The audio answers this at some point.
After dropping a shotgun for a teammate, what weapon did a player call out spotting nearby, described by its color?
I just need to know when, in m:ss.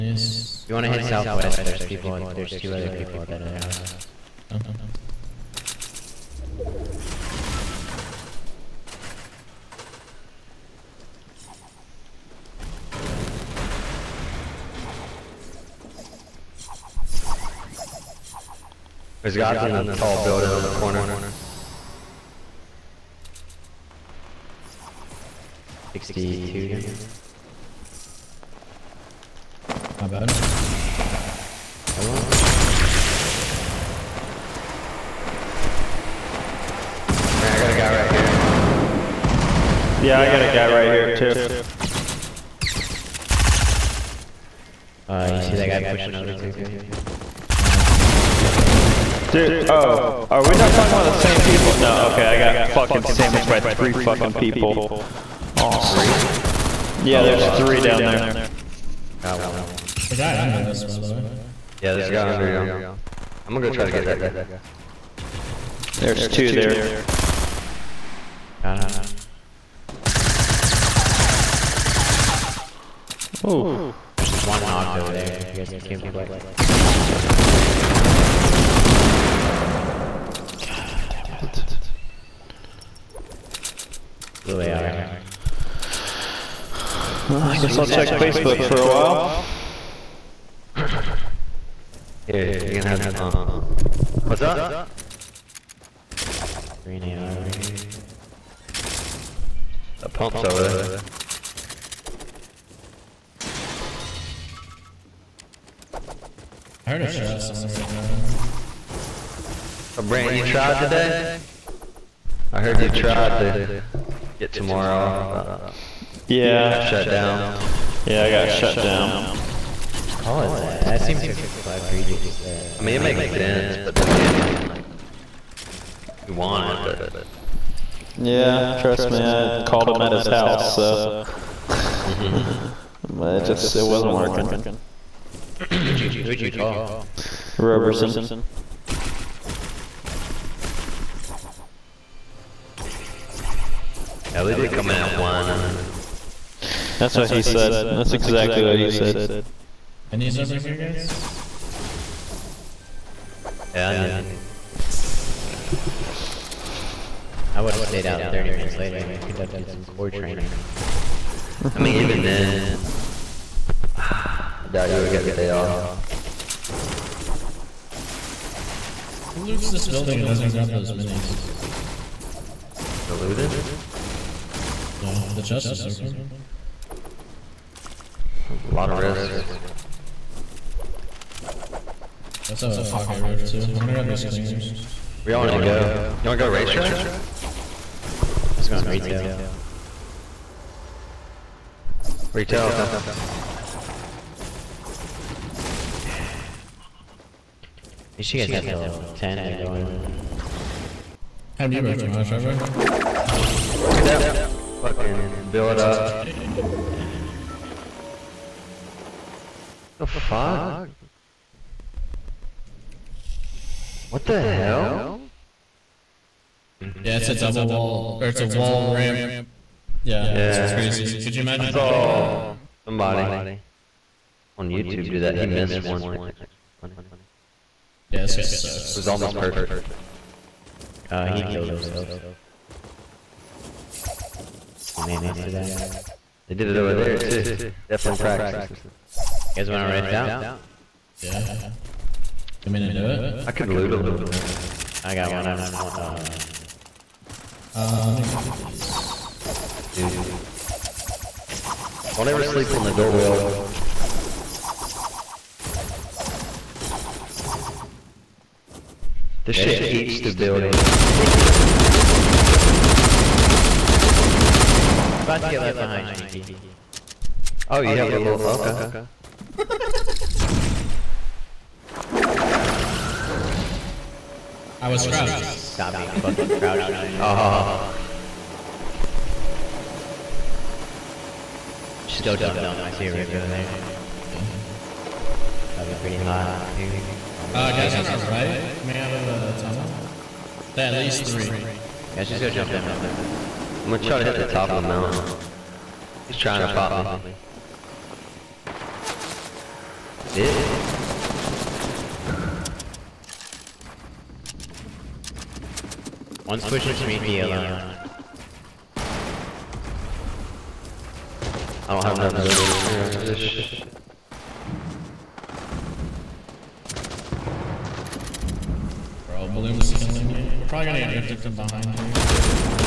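1:36.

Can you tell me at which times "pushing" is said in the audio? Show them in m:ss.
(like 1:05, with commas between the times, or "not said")
0:45, 5:06.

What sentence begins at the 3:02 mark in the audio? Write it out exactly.
Let's have a pocket roof too.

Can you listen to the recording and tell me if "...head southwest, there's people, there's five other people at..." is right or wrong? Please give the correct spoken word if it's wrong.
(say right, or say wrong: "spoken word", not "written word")
wrong: "two", not "five".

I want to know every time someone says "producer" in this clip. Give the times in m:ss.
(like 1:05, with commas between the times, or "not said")
not said.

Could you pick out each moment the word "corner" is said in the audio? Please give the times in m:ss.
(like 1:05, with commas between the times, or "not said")
0:20.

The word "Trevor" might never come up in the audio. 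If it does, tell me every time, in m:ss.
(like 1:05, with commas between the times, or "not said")
3:22.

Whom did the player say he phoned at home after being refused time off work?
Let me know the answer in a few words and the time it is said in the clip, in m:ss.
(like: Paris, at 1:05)
Roberson, at 2:17.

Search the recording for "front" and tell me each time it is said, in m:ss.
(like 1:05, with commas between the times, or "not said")
not said.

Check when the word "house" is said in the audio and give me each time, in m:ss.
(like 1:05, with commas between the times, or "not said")
0:03, 2:10.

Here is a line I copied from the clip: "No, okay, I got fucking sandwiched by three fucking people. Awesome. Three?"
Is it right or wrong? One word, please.
right.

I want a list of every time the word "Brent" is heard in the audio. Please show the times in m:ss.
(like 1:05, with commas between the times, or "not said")
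1:50.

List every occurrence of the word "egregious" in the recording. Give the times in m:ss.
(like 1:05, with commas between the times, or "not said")
2:01.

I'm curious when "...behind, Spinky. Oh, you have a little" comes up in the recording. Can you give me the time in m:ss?
4:25.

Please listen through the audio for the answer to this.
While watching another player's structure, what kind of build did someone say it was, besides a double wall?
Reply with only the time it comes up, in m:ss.
3:38.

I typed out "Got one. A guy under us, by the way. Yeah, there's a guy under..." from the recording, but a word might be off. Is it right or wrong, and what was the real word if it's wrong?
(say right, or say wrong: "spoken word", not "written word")
right.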